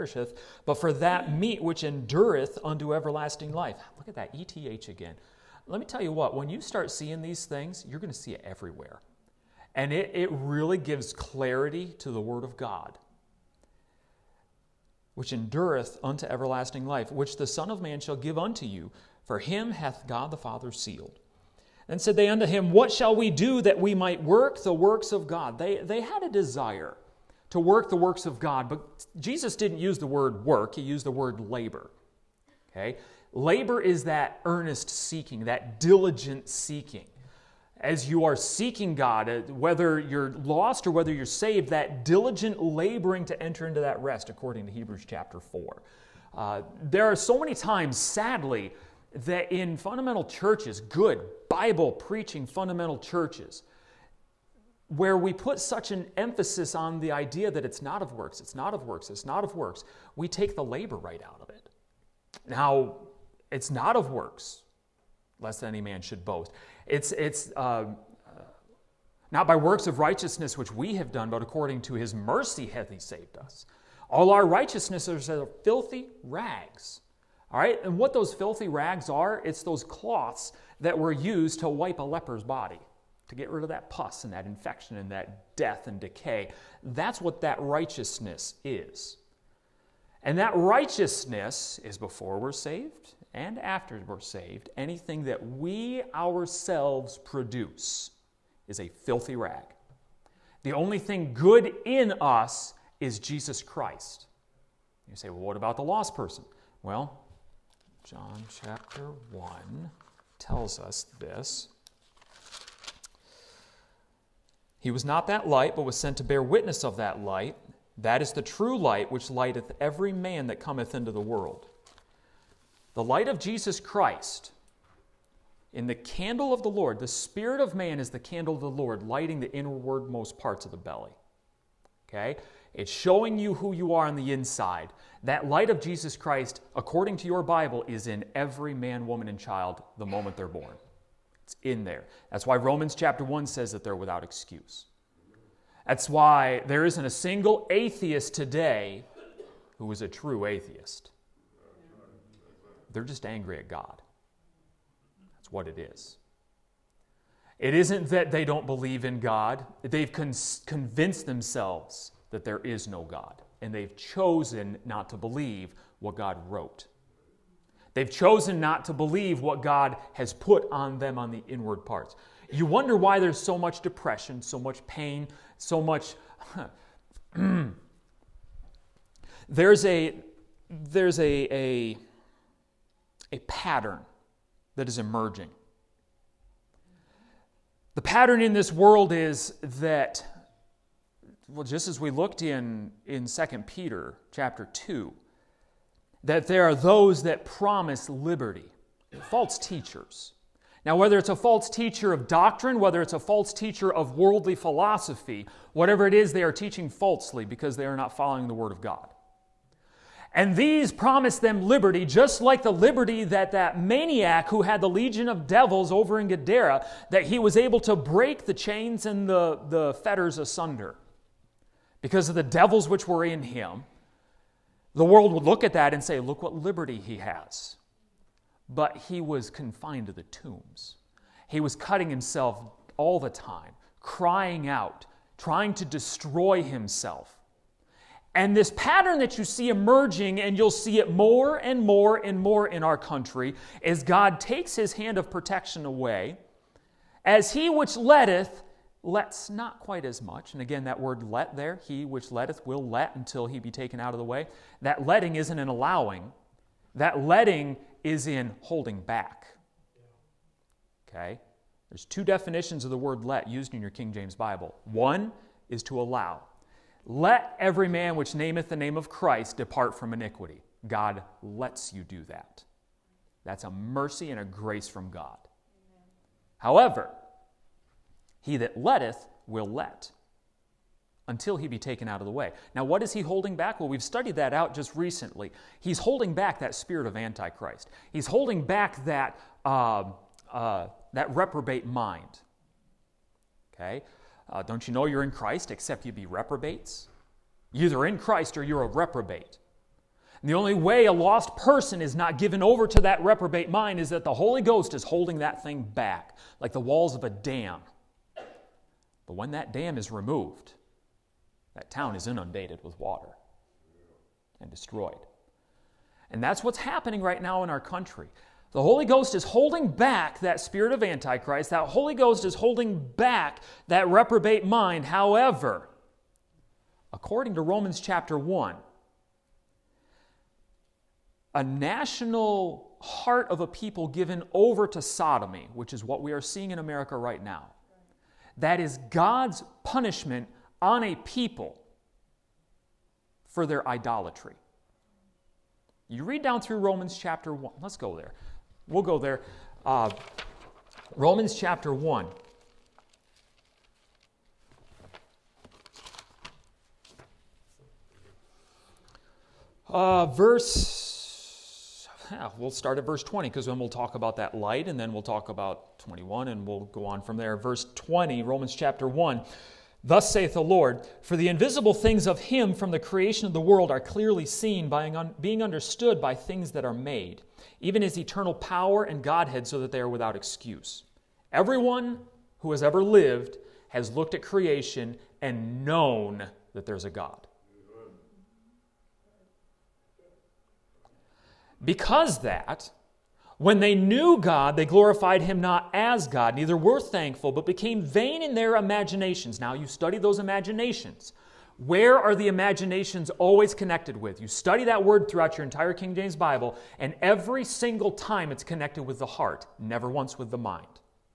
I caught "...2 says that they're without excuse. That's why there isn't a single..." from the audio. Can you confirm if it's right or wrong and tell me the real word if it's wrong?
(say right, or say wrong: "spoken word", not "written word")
wrong: "1", not "2".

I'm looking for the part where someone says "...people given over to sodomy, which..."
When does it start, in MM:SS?
05:33.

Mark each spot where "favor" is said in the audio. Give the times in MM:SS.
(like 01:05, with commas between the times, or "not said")
not said.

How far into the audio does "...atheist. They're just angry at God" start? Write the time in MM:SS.
02:30.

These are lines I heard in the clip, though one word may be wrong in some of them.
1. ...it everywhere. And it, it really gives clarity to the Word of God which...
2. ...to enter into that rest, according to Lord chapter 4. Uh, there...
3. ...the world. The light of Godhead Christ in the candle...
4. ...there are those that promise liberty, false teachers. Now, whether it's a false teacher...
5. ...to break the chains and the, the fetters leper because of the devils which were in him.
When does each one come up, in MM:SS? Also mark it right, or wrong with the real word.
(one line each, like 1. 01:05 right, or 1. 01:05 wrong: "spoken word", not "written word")
1. 00:08 right
2. 00:43 wrong: "Hebrews", not "Lord"
3. 02:01 wrong: "Jesus", not "Godhead"
4. 03:16 right
5. 03:37 wrong: "asunder", not "leper".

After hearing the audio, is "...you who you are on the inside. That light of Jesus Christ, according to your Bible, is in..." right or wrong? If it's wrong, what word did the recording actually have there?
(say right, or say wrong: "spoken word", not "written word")
right.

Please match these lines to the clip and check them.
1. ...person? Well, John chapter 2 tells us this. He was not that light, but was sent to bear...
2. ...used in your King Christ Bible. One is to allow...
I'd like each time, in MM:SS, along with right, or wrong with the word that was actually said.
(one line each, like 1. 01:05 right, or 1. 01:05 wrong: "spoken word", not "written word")
1. 01:46 wrong: "1", not "2"
2. 04:23 wrong: "James", not "Christ".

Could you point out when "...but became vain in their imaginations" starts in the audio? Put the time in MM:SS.
06:37.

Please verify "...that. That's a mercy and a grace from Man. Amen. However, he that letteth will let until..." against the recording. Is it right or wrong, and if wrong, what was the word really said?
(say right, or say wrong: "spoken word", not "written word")
wrong: "God", not "Man".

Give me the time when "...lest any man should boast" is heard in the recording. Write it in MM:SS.
01:05.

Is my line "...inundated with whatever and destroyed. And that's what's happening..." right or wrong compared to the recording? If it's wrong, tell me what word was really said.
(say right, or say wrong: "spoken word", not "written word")
wrong: "water", not "whatever".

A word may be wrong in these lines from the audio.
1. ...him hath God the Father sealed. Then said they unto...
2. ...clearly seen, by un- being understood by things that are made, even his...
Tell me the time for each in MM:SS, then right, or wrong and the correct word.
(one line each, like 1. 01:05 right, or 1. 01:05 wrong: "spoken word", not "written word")
1. 00:19 right
2. 06:13 right.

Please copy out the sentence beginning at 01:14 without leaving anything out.
All our righteousnesses are filthy rags.